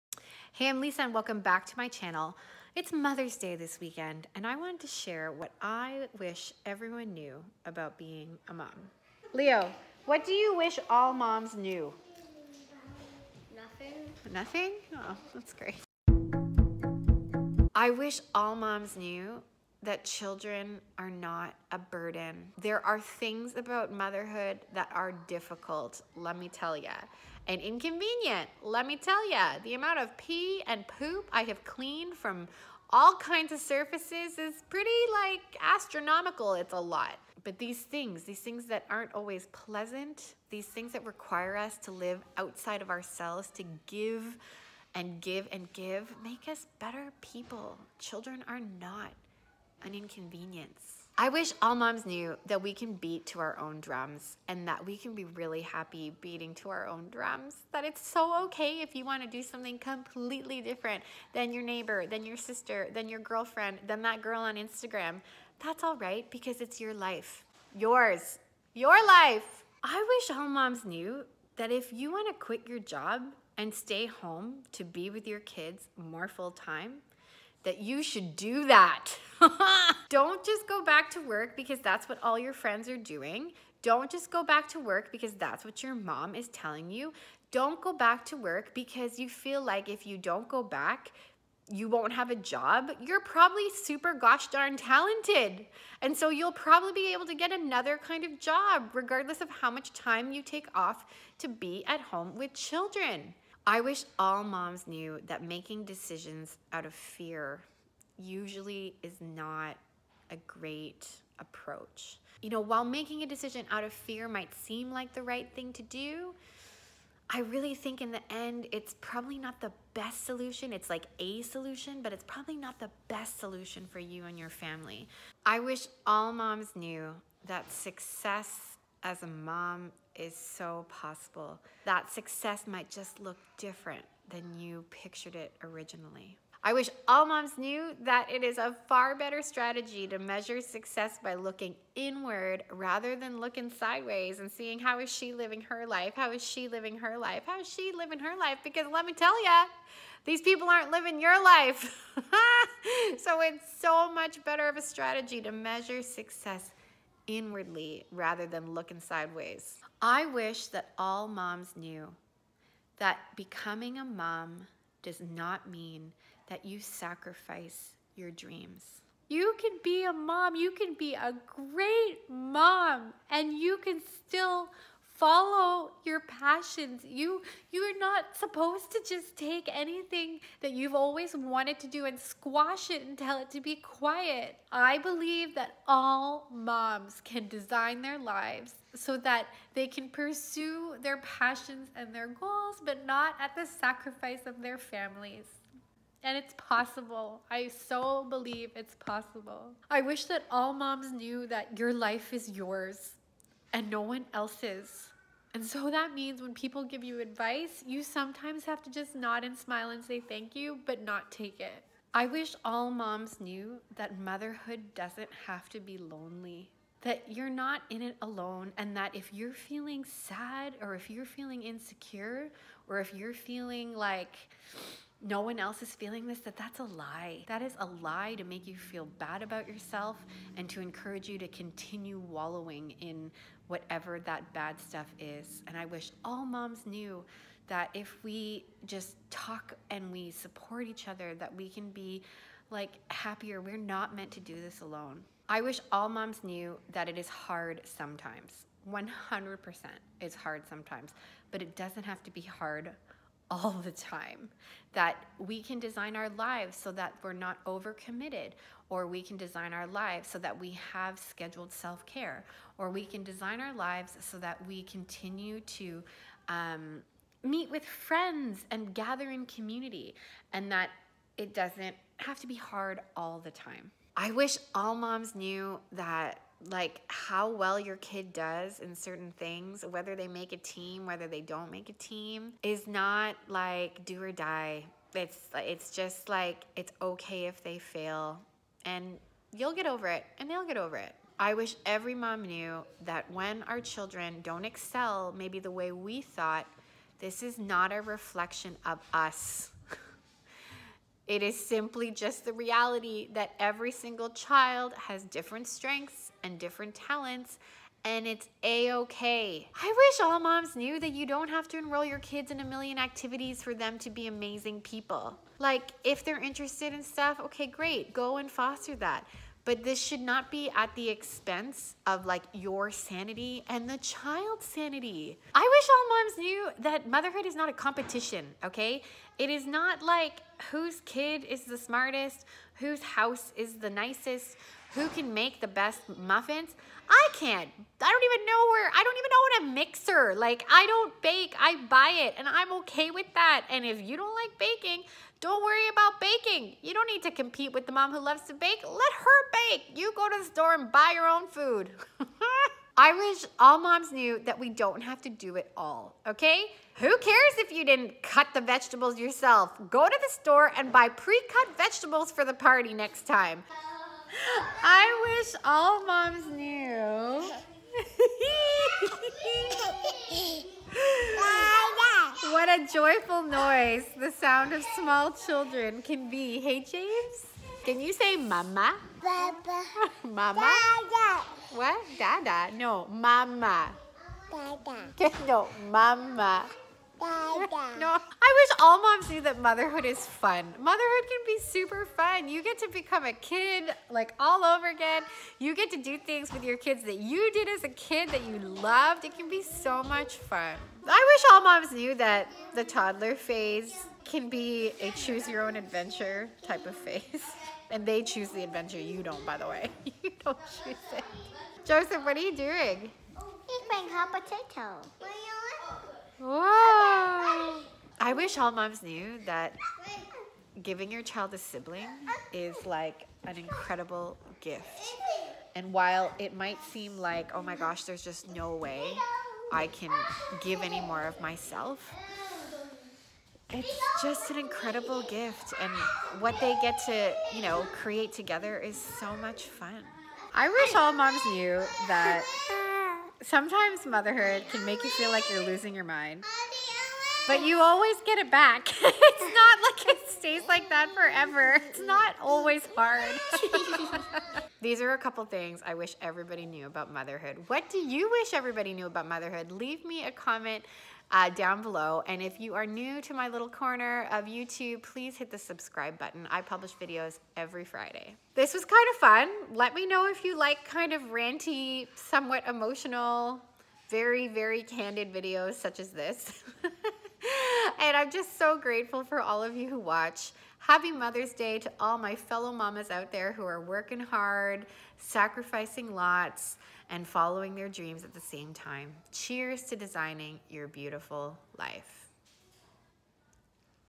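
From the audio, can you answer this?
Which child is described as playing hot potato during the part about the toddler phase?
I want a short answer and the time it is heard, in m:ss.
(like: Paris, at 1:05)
Joseph, at 6:51.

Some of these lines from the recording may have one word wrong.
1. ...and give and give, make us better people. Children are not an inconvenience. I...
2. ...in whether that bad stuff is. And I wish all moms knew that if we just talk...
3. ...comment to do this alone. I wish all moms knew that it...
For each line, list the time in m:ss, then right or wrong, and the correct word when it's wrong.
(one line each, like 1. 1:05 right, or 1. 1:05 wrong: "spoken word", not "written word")
1. 0:44 right
2. 3:53 wrong: "whatever", not "whether"
3. 4:04 wrong: "meant", not "comment".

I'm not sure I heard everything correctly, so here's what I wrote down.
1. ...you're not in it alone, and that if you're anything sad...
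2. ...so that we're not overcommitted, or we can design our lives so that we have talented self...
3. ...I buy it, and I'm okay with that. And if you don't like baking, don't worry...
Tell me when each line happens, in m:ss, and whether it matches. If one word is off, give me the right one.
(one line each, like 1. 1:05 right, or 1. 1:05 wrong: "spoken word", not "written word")
1. 3:37 wrong: "feeling", not "anything"
2. 4:16 wrong: "scheduled", not "talented"
3. 5:41 right.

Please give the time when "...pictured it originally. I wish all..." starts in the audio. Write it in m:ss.
2:14.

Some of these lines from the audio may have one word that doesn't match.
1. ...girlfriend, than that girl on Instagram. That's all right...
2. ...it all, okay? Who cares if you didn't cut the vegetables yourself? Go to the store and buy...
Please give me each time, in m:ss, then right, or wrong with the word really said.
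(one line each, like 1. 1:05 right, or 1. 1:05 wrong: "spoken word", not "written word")
1. 1:03 right
2. 5:55 right.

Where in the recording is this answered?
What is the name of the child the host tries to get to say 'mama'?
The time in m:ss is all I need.
6:16.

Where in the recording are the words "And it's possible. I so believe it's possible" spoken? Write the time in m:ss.
3:16.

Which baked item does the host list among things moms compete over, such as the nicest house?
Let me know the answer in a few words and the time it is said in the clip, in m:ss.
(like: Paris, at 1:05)
muffins, at 5:36.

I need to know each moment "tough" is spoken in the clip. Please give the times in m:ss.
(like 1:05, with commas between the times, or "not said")
not said.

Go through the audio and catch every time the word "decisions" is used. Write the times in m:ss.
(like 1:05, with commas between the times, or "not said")
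1:45, 1:53.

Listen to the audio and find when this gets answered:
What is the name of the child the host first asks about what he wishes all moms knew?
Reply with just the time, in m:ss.
0:09.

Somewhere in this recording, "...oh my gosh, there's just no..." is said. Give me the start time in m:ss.
7:07.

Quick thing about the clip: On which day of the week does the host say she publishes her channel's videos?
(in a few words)
Friday.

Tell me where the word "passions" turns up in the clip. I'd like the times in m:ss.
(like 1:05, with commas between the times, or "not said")
2:56, 3:11.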